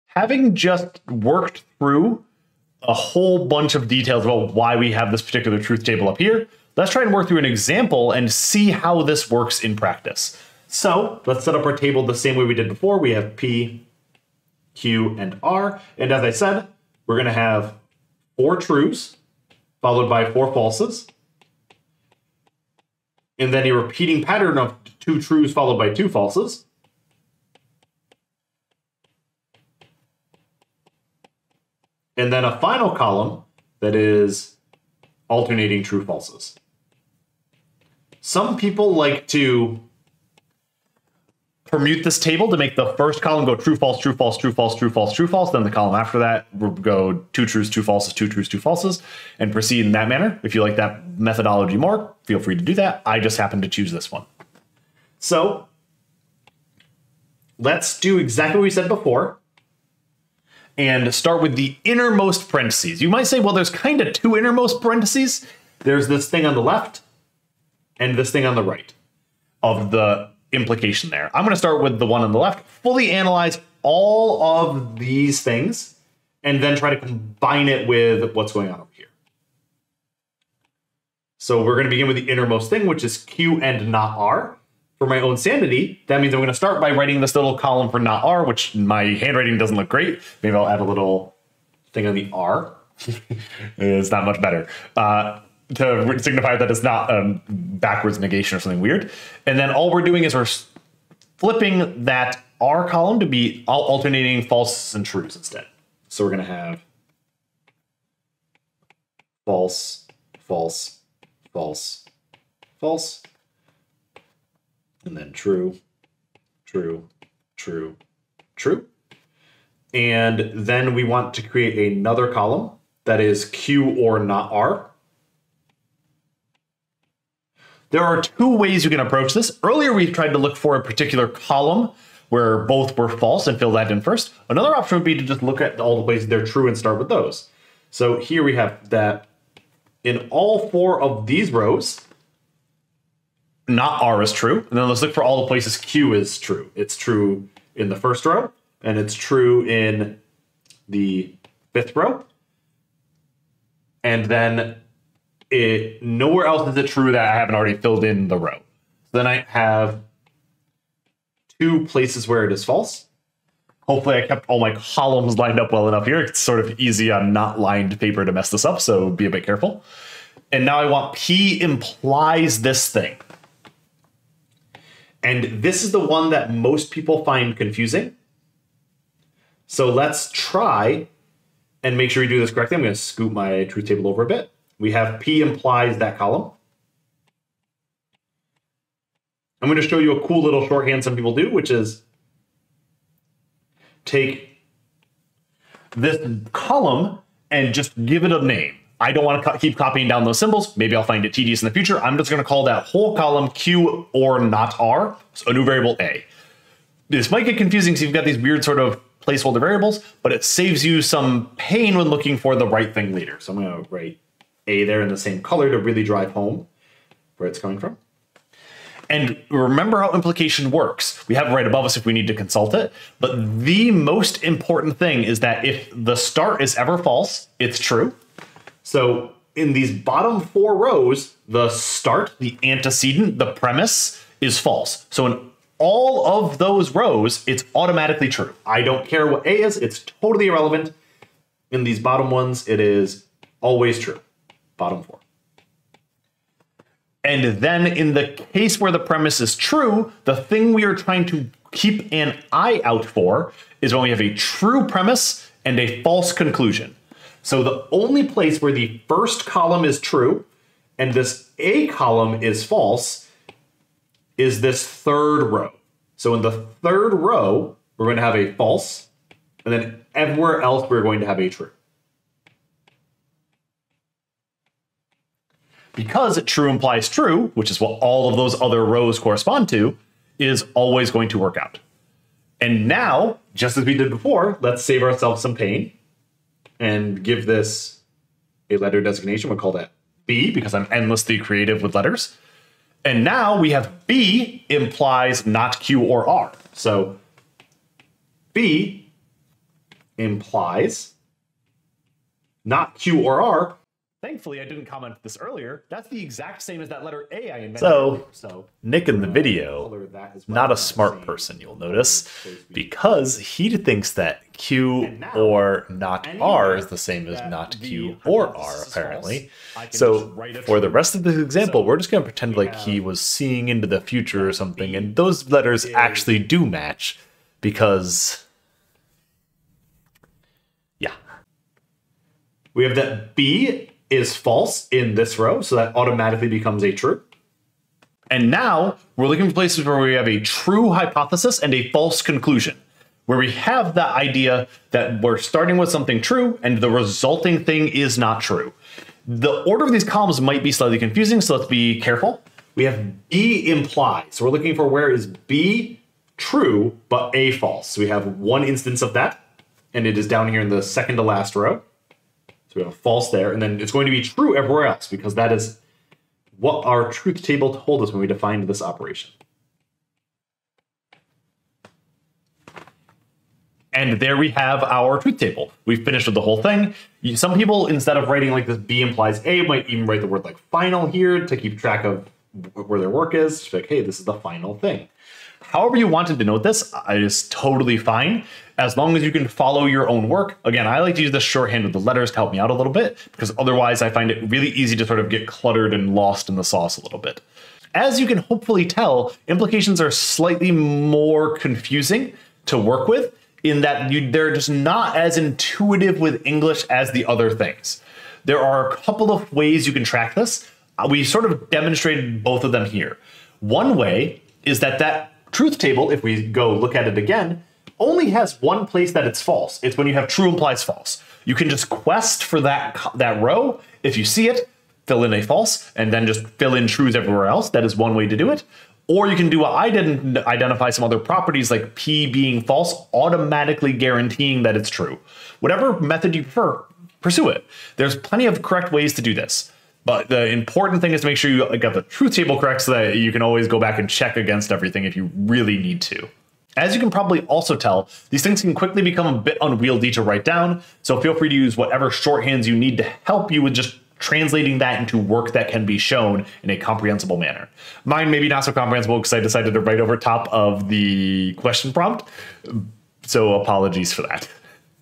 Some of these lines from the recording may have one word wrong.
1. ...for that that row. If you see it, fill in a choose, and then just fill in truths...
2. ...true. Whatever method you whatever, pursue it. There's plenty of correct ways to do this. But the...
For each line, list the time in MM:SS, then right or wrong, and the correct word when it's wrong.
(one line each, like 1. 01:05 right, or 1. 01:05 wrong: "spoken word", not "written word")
1. 07:02 wrong: "false", not "choose"
2. 07:14 wrong: "prefer", not "whatever".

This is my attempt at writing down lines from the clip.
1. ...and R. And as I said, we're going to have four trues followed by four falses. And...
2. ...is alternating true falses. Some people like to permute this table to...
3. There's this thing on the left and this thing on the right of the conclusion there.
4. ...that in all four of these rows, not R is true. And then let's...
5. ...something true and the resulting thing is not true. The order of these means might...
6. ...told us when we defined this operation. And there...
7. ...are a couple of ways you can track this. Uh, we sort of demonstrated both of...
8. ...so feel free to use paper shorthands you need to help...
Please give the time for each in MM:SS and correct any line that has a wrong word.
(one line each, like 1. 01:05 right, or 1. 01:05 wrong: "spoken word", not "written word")
1. 00:15 right
2. 00:33 right
3. 01:05 wrong: "implication", not "conclusion"
4. 02:18 right
5. 05:45 wrong: "columns", not "means"
6. 06:07 right
7. 06:48 right
8. 07:31 wrong: "whatever", not "paper".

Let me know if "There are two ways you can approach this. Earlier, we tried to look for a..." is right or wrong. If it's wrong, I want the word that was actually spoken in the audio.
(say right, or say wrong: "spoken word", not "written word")
right.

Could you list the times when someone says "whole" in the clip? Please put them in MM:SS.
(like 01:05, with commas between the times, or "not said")
00:02, 03:22, 06:16.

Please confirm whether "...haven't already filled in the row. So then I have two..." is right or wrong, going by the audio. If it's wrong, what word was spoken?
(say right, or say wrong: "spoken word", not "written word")
right.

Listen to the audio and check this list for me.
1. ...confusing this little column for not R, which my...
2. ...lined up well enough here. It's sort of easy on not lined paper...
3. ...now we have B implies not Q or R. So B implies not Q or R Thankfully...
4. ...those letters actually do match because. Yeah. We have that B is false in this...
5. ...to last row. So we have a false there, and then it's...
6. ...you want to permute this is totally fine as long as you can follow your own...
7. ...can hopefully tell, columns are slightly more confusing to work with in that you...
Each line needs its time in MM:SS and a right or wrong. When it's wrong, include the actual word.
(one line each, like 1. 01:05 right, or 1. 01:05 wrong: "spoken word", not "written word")
1. 01:26 wrong: "writing", not "confusing"
2. 02:45 right
3. 04:53 right
4. 05:25 right
5. 06:01 right
6. 06:25 wrong: "denote", not "permute"
7. 06:38 wrong: "implications", not "columns".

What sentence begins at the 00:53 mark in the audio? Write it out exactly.
I just happen to choose this one.